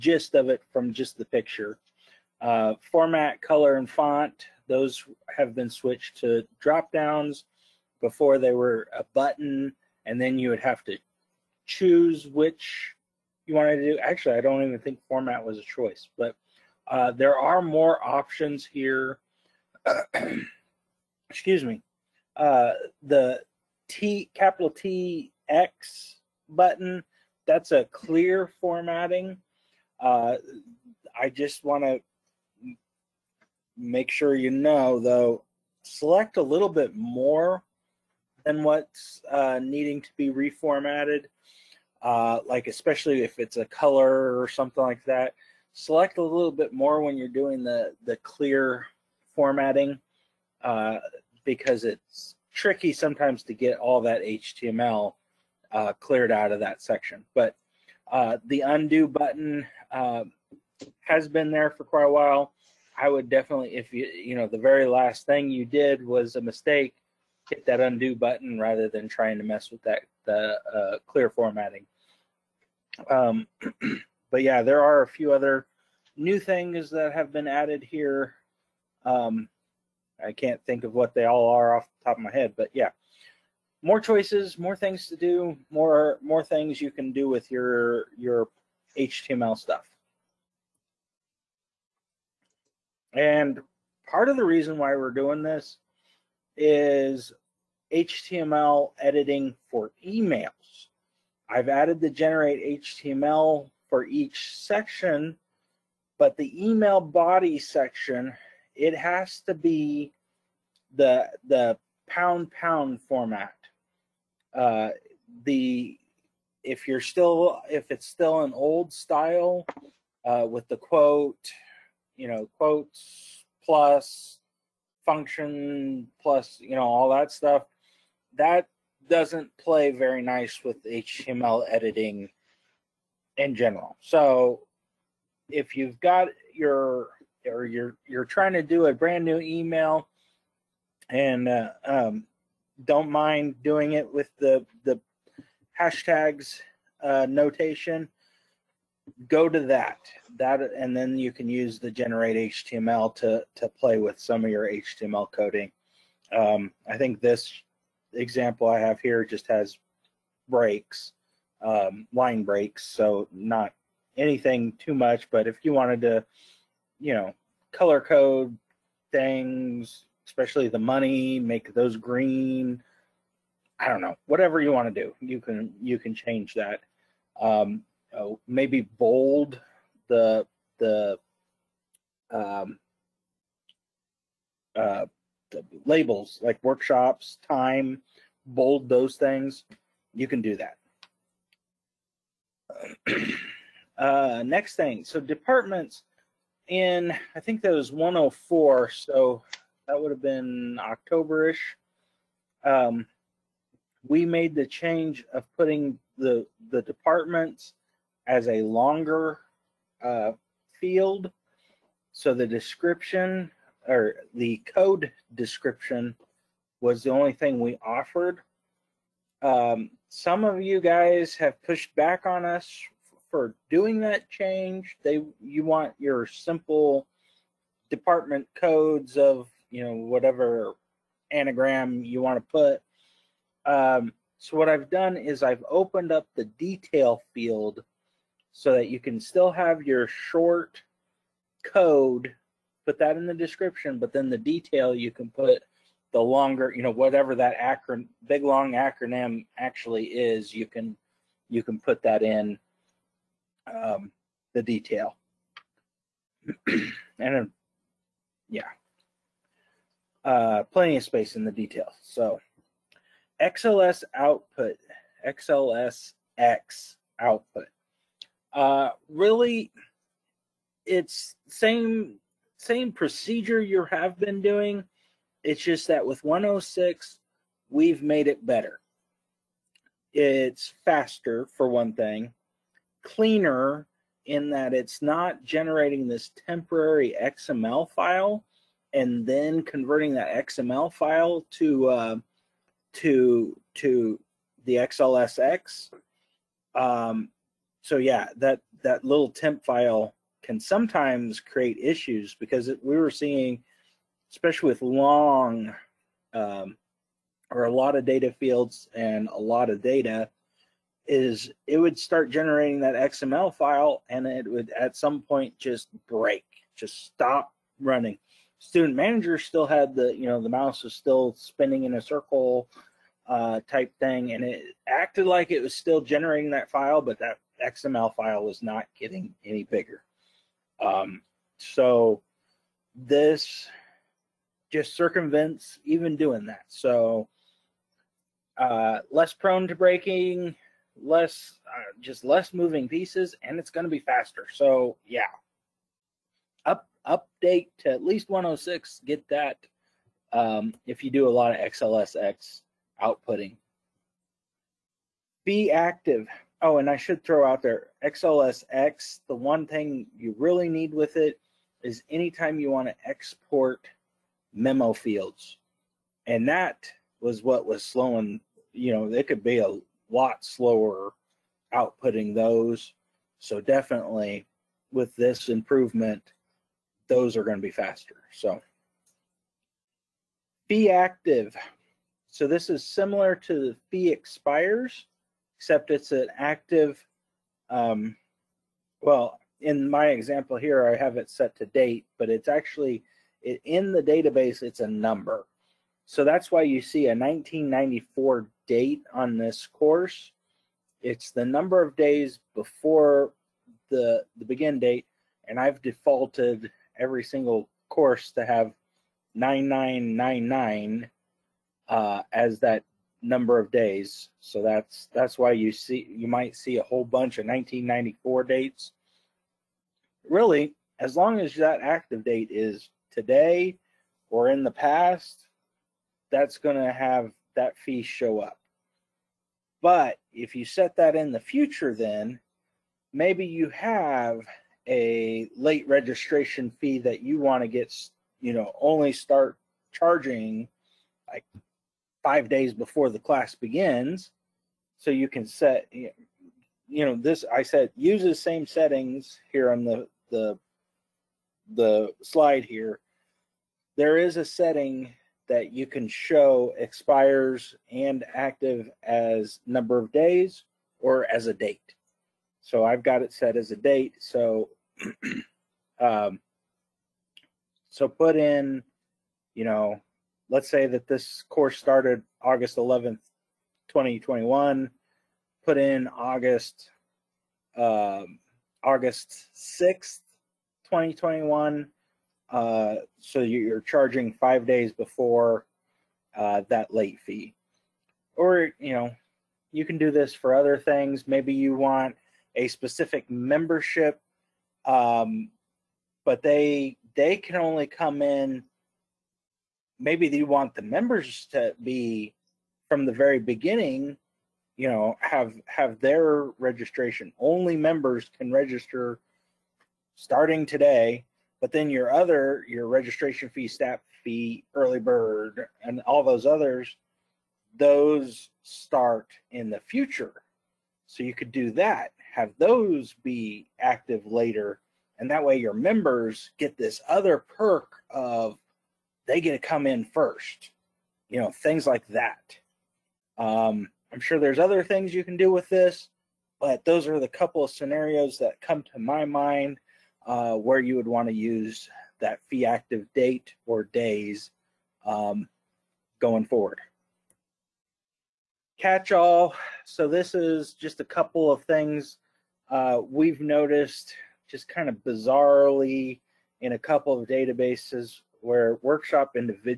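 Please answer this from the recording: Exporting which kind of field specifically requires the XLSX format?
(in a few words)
memo fields.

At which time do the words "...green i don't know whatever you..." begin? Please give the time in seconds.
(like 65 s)
171 s.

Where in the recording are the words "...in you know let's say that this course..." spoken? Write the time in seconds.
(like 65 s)
468 s.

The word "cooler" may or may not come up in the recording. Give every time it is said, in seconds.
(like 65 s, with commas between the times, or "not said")
not said.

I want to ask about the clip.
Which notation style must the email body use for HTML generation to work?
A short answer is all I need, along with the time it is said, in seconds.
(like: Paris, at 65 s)
pound pound format, at 112 s.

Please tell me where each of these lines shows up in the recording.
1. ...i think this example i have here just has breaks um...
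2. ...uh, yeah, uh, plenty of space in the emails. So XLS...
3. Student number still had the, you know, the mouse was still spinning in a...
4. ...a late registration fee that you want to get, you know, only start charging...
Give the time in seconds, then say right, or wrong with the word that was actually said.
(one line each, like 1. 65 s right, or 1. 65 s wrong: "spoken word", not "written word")
1. 156 s right
2. 257 s wrong: "details", not "emails"
3. 318 s wrong: "manager", not "number"
4. 434 s right.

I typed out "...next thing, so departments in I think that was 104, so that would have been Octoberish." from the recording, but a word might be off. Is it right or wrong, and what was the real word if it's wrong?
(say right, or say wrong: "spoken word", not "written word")
right.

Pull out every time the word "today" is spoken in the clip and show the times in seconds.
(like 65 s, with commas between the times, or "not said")
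423 s, 510 s.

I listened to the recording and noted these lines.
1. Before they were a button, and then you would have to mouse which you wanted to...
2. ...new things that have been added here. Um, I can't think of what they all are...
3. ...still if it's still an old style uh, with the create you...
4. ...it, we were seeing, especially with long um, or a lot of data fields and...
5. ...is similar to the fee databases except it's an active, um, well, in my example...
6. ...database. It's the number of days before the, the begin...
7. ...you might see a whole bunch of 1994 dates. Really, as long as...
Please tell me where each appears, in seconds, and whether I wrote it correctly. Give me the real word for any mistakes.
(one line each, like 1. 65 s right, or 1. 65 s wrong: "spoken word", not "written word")
1. 8 s wrong: "choose", not "mouse"
2. 76 s right
3. 117 s wrong: "quote", not "create"
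4. 302 s right
5. 382 s wrong: "expires", not "databases"
6. 399 s wrong: "course", not "database"
7. 416 s right.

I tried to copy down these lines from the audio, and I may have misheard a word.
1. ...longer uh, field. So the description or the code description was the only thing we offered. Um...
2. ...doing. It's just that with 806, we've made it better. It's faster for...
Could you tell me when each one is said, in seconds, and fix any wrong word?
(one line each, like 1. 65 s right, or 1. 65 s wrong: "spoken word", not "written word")
1. 208 s right
2. 274 s wrong: "106", not "806".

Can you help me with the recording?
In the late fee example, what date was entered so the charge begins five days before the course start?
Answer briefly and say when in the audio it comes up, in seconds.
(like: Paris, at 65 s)
August 6th, 2021, at 478 s.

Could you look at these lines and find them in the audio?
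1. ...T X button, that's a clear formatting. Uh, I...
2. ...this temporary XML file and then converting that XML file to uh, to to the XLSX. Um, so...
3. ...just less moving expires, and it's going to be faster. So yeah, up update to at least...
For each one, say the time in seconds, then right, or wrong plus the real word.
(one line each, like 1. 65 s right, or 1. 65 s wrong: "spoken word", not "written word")
1. 24 s right
2. 286 s right
3. 342 s wrong: "pieces", not "expires".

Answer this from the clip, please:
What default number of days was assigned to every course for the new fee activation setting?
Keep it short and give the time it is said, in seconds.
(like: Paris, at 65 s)
9999, at 409 s.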